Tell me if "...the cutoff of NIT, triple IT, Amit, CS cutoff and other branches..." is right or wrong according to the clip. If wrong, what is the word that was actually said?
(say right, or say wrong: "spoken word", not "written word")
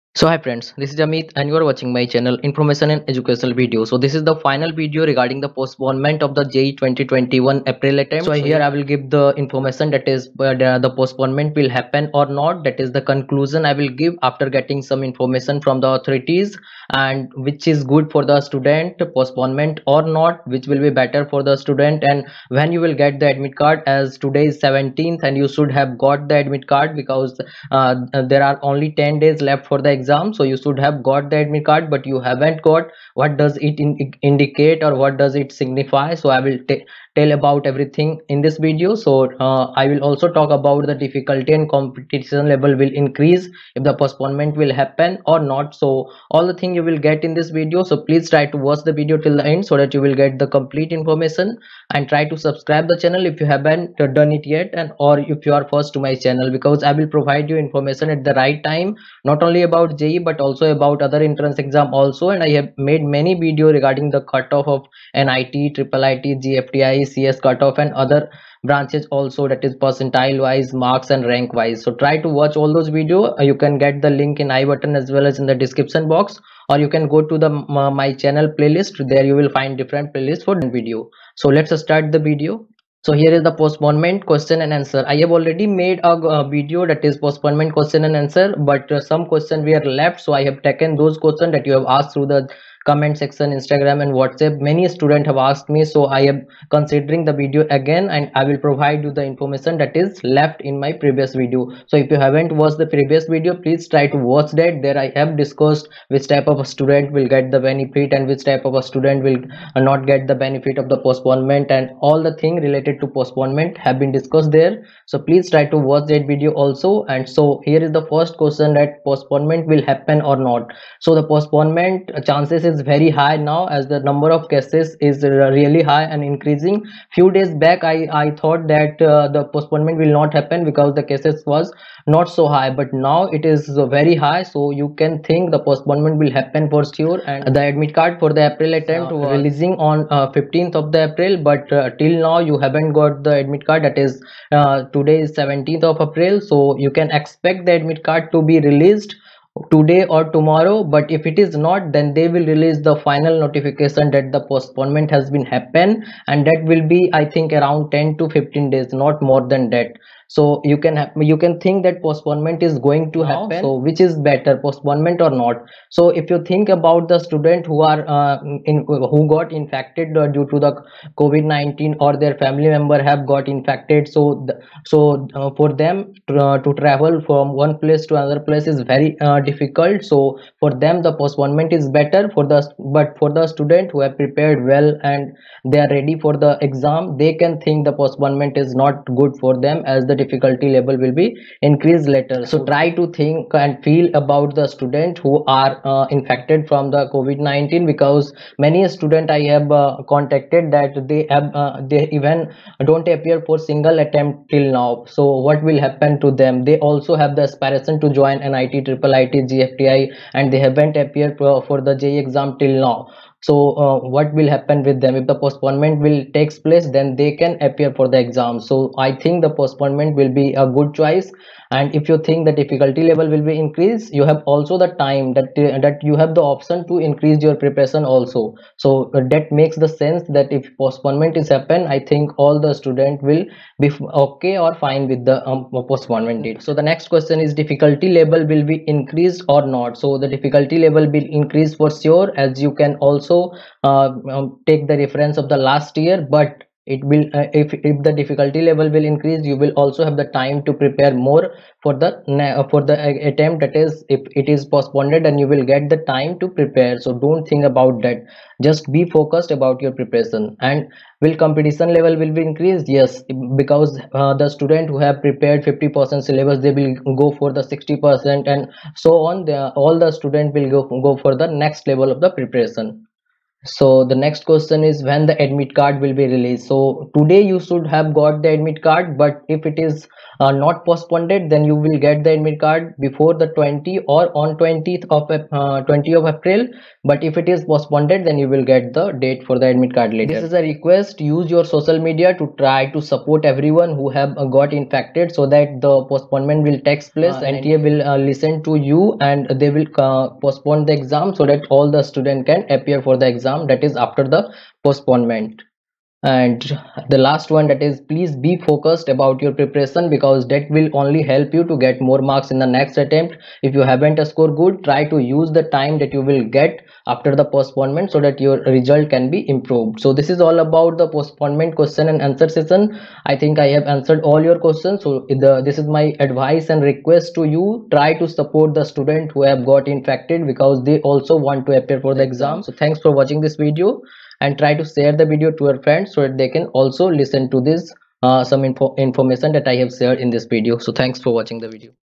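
wrong: "GFTI", not "Amit".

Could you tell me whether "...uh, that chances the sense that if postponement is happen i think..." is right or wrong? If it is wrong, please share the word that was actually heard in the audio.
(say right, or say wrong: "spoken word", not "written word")
wrong: "makes", not "chances".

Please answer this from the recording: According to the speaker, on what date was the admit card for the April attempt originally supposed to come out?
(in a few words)
15th of April.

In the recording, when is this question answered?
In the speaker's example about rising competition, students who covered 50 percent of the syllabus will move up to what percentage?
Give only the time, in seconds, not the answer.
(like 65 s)
267 s.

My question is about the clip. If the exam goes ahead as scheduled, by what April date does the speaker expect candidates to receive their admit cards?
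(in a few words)
20th April.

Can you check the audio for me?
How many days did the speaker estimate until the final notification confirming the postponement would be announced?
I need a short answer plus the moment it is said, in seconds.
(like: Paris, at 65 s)
10 to 15 days, at 157 s.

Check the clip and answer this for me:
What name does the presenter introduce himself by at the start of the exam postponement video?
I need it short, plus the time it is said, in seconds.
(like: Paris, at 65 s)
Amit, at 0 s.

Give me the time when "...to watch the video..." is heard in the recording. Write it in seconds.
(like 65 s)
48 s.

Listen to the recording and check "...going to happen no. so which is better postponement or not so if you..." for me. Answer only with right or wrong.
right.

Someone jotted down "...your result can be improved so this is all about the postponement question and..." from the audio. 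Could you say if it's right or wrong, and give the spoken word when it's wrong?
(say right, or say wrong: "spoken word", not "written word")
right.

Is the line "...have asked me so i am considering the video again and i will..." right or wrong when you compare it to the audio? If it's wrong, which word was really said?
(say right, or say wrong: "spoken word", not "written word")
right.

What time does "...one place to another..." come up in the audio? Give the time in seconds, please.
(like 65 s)
177 s.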